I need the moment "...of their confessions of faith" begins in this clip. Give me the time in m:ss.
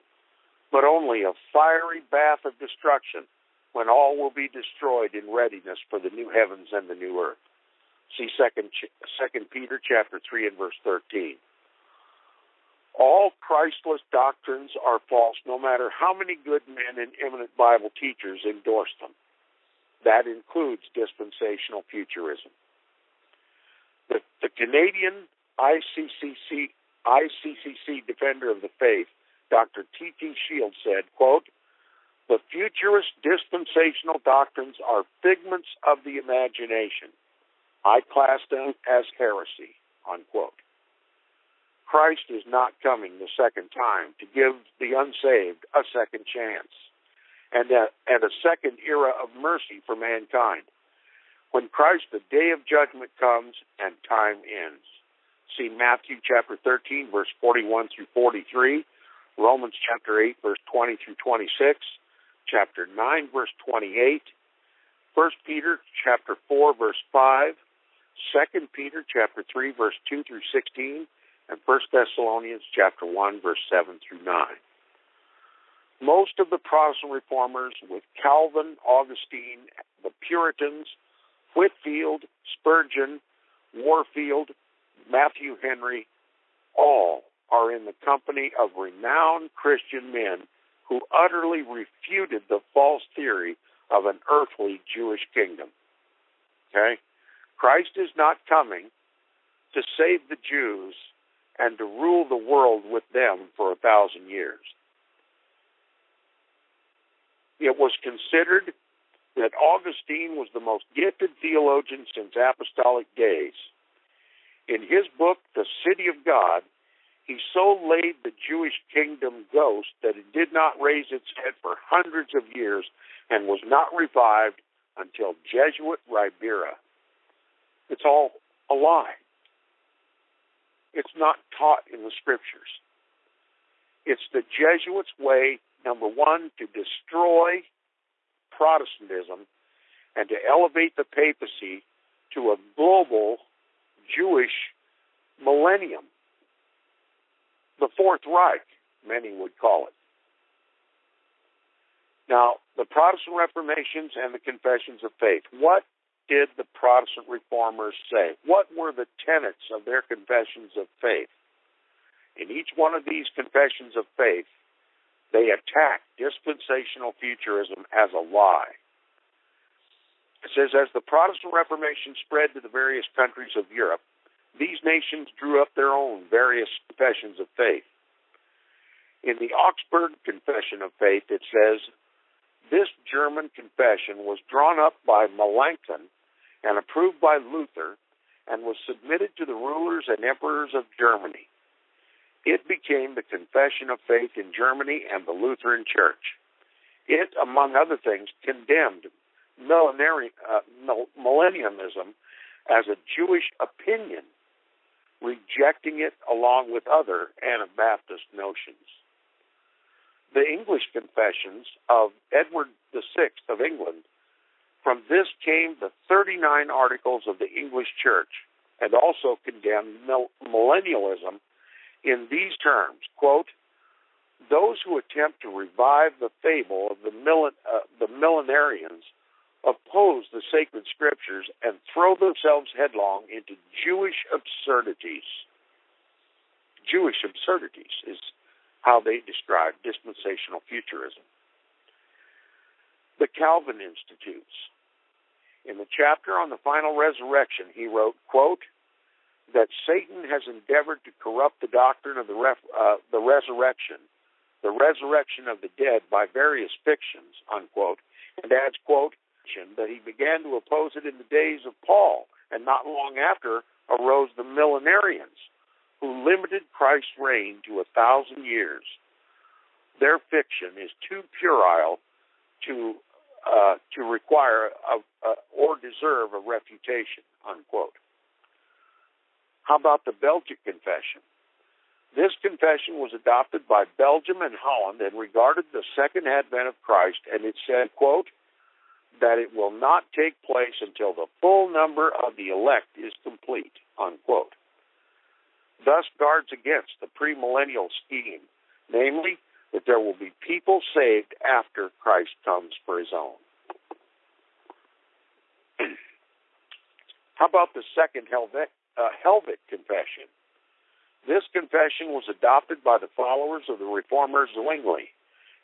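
2:39.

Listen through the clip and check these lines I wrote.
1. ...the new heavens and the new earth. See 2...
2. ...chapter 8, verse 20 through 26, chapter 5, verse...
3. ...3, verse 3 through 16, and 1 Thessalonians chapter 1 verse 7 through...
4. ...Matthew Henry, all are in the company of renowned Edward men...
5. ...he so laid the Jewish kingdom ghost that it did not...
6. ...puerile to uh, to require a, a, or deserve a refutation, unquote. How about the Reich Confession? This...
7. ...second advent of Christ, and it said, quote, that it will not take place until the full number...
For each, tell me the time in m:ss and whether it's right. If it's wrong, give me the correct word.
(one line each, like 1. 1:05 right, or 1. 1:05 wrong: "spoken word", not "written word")
1. 0:05 right
2. 0:59 wrong: "9", not "5"
3. 1:09 wrong: "2", not "3"
4. 1:24 wrong: "Christian", not "Edward"
5. 1:57 right
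6. 4:31 wrong: "Belgic", not "Reich"
7. 4:45 right.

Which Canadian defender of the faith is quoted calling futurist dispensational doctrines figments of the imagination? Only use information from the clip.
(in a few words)
T.T. Shields.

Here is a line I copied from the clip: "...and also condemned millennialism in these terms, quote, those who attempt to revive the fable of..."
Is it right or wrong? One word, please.
right.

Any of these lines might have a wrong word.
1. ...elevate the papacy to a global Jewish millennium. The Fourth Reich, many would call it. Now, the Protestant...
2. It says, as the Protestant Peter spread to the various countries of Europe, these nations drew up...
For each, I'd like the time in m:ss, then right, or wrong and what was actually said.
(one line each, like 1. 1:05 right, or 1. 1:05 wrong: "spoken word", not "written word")
1. 2:20 right
2. 2:50 wrong: "Reformation", not "Peter".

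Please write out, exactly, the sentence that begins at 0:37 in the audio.
I class them as heresy, unquote.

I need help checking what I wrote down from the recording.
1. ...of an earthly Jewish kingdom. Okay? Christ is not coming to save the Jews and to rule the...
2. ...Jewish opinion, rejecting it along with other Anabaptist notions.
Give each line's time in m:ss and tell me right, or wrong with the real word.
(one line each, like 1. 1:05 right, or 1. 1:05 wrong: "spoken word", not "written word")
1. 1:33 right
2. 3:23 right.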